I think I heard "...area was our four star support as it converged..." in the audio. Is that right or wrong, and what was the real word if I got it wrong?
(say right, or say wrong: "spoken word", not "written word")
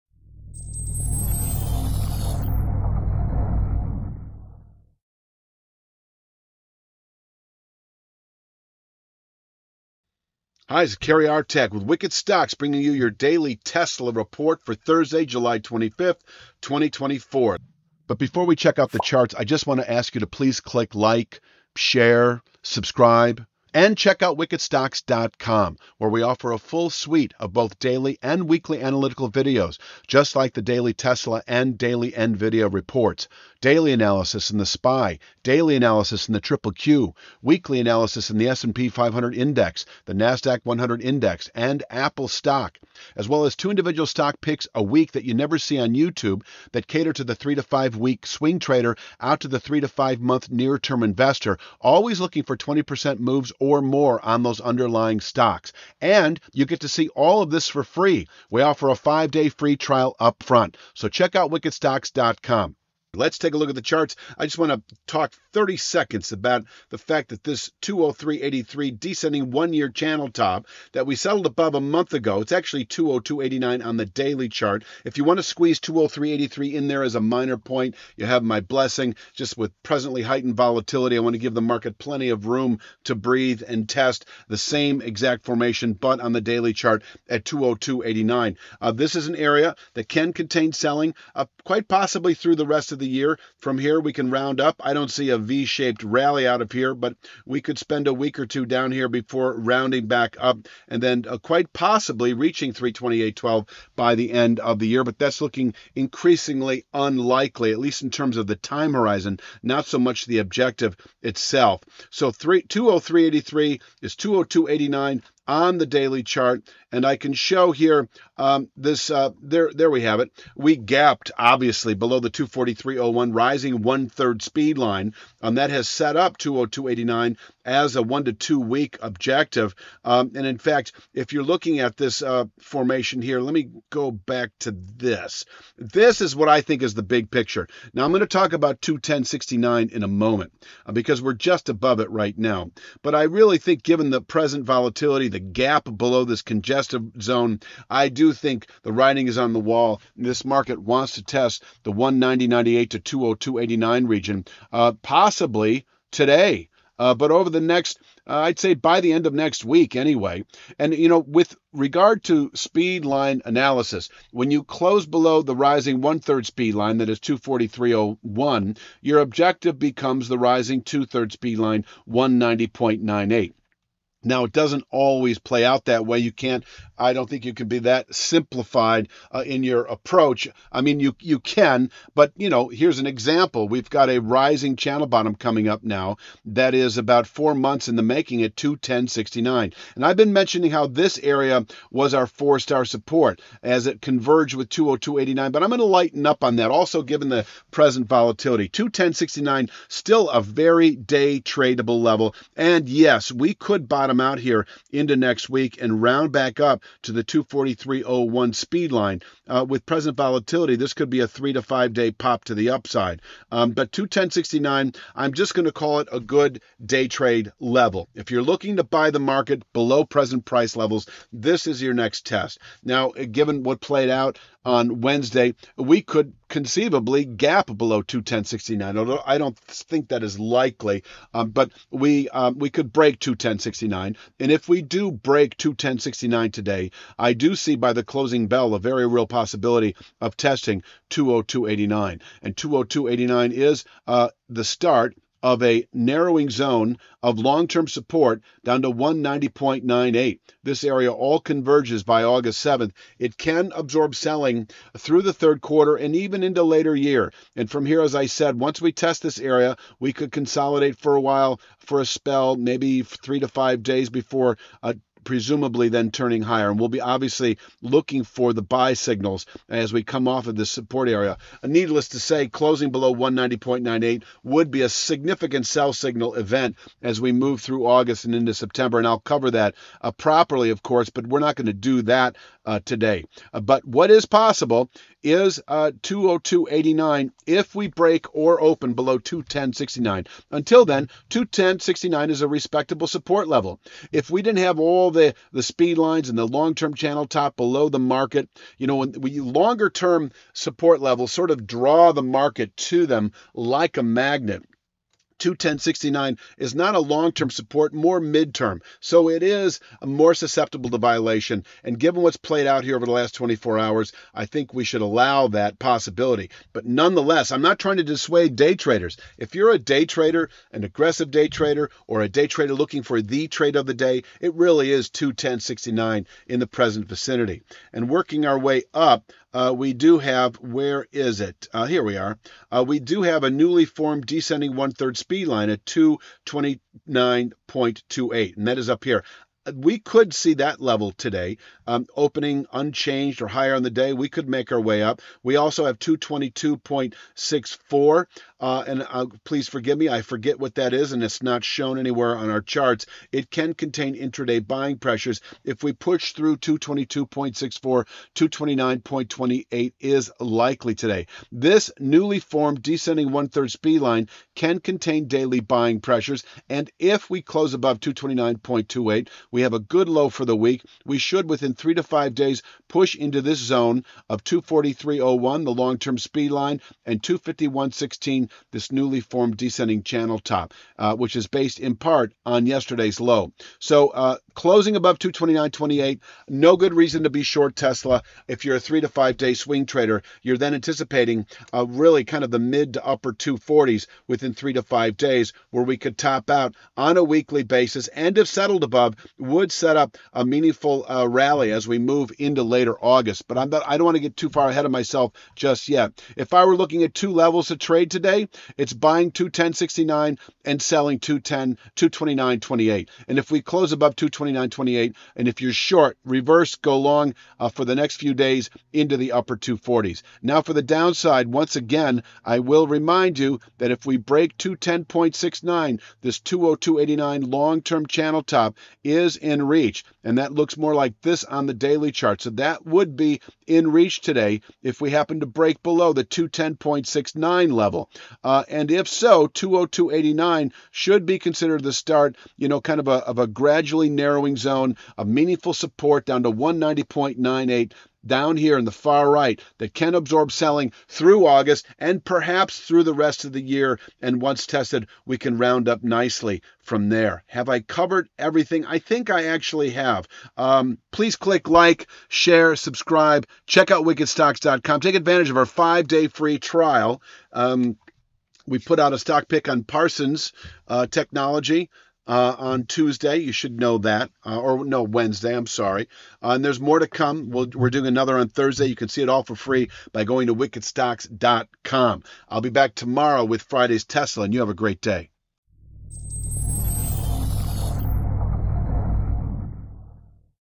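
right.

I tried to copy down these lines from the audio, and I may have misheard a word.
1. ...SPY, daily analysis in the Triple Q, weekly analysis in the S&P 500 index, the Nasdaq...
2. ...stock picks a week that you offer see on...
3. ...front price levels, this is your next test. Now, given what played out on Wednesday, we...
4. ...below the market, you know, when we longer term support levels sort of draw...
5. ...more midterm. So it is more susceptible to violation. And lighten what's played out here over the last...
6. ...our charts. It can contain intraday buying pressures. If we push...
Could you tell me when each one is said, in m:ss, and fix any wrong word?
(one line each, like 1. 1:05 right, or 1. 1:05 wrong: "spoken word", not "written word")
1. 0:34 right
2. 0:44 wrong: "never", not "offer"
3. 3:40 wrong: "present", not "front"
4. 4:57 right
5. 5:07 wrong: "given", not "lighten"
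6. 5:52 right.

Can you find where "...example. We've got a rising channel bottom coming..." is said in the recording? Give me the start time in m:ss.
3:03.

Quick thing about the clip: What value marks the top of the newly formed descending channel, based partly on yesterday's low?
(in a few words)
251.16.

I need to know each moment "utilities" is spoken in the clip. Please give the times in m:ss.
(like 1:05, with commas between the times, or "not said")
not said.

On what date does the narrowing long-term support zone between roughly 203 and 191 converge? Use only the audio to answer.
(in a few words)
August 7th.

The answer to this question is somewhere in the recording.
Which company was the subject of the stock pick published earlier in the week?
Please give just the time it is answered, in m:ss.
7:49.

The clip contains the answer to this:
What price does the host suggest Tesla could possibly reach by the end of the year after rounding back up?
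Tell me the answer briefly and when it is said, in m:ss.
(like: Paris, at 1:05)
328.12, at 1:42.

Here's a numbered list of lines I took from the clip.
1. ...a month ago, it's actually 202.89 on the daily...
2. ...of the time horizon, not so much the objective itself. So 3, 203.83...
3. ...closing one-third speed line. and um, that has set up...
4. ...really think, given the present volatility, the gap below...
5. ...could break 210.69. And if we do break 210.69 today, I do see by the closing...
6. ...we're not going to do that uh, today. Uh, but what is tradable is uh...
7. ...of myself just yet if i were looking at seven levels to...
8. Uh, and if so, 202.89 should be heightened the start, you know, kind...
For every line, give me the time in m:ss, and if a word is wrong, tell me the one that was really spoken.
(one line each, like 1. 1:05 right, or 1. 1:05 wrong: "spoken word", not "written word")
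1. 1:11 right
2. 1:48 right
3. 2:03 wrong: "rising", not "closing"
4. 2:23 right
5. 3:52 right
6. 4:41 wrong: "possible", not "tradable"
7. 6:44 wrong: "two", not "seven"
8. 7:18 wrong: "considered", not "heightened".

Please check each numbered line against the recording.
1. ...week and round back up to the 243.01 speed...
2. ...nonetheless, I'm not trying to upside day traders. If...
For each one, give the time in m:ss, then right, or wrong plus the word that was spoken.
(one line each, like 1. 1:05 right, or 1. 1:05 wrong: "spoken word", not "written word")
1. 3:25 right
2. 5:16 wrong: "dissuade", not "upside".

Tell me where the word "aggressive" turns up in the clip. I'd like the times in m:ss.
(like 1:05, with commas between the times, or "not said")
5:20.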